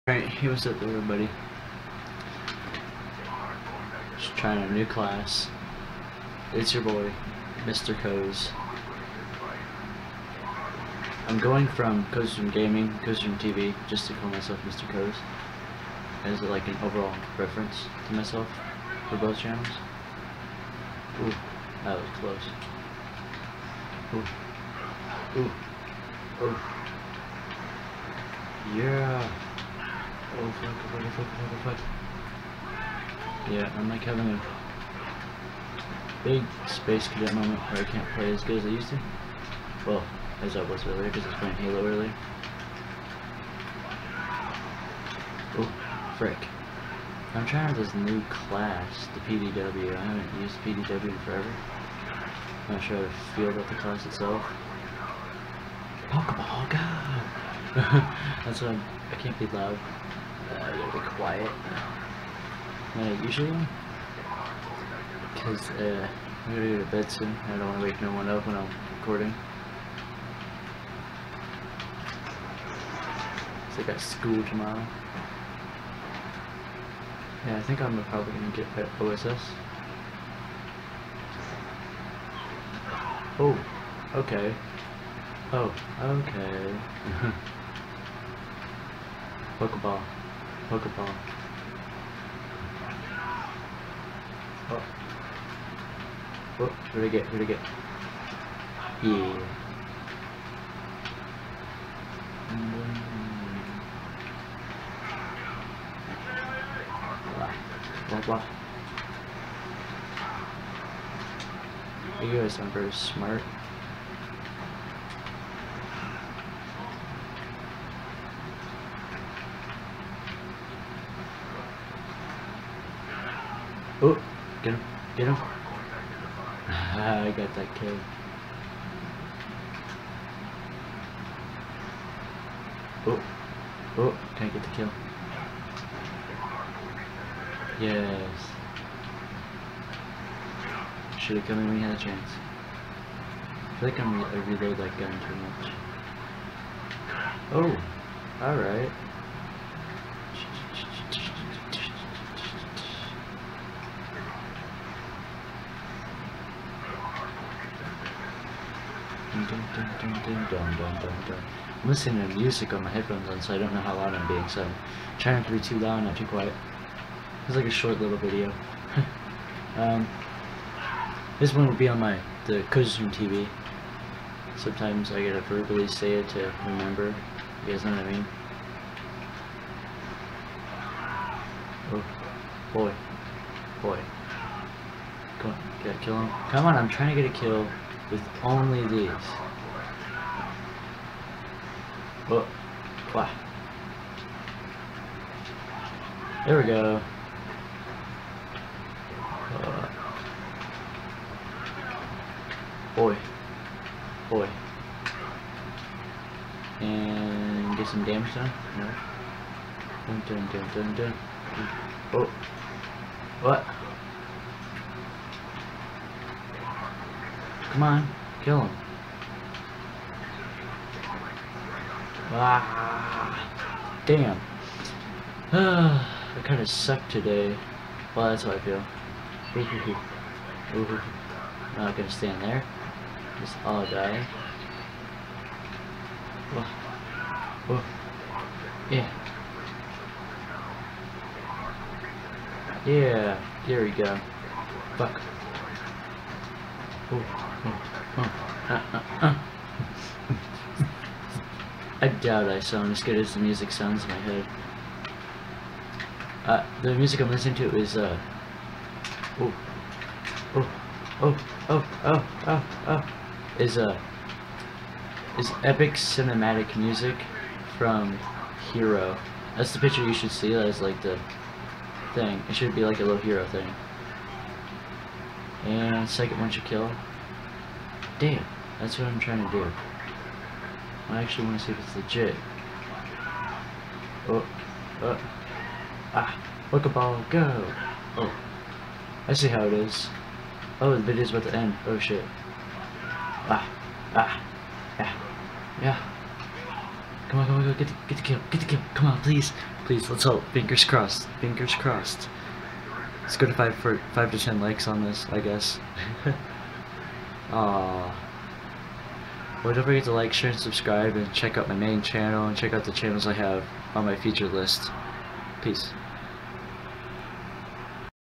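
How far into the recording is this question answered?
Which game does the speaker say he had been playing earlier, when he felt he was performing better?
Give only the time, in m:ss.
0:41.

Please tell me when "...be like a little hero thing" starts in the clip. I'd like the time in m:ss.
4:32.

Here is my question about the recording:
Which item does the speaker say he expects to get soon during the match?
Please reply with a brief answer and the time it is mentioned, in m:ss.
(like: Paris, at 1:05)
OSS, at 1:18.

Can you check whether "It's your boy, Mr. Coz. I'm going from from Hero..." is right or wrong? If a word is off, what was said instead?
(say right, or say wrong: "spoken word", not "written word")
wrong: "Gaming", not "Hero".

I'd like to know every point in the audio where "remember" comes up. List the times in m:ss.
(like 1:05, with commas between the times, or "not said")
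2:56.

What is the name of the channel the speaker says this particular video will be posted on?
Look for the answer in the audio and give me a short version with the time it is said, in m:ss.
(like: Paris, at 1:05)
Coziestroom TV, at 2:52.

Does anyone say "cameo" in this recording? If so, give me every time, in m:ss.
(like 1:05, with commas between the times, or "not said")
not said.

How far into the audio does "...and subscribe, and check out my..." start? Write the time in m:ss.
5:10.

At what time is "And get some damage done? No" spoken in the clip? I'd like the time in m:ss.
3:26.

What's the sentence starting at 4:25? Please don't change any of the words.
Is epic cinematic music from Hero.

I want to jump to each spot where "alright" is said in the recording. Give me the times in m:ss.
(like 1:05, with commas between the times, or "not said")
0:00, 2:28.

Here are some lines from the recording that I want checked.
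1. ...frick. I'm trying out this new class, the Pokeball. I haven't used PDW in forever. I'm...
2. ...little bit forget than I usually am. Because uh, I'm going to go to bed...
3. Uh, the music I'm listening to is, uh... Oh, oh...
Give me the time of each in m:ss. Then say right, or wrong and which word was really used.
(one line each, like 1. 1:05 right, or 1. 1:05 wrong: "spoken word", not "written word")
1. 0:46 wrong: "PDW", not "Pokeball"
2. 1:00 wrong: "quiet", not "forget"
3. 4:16 right.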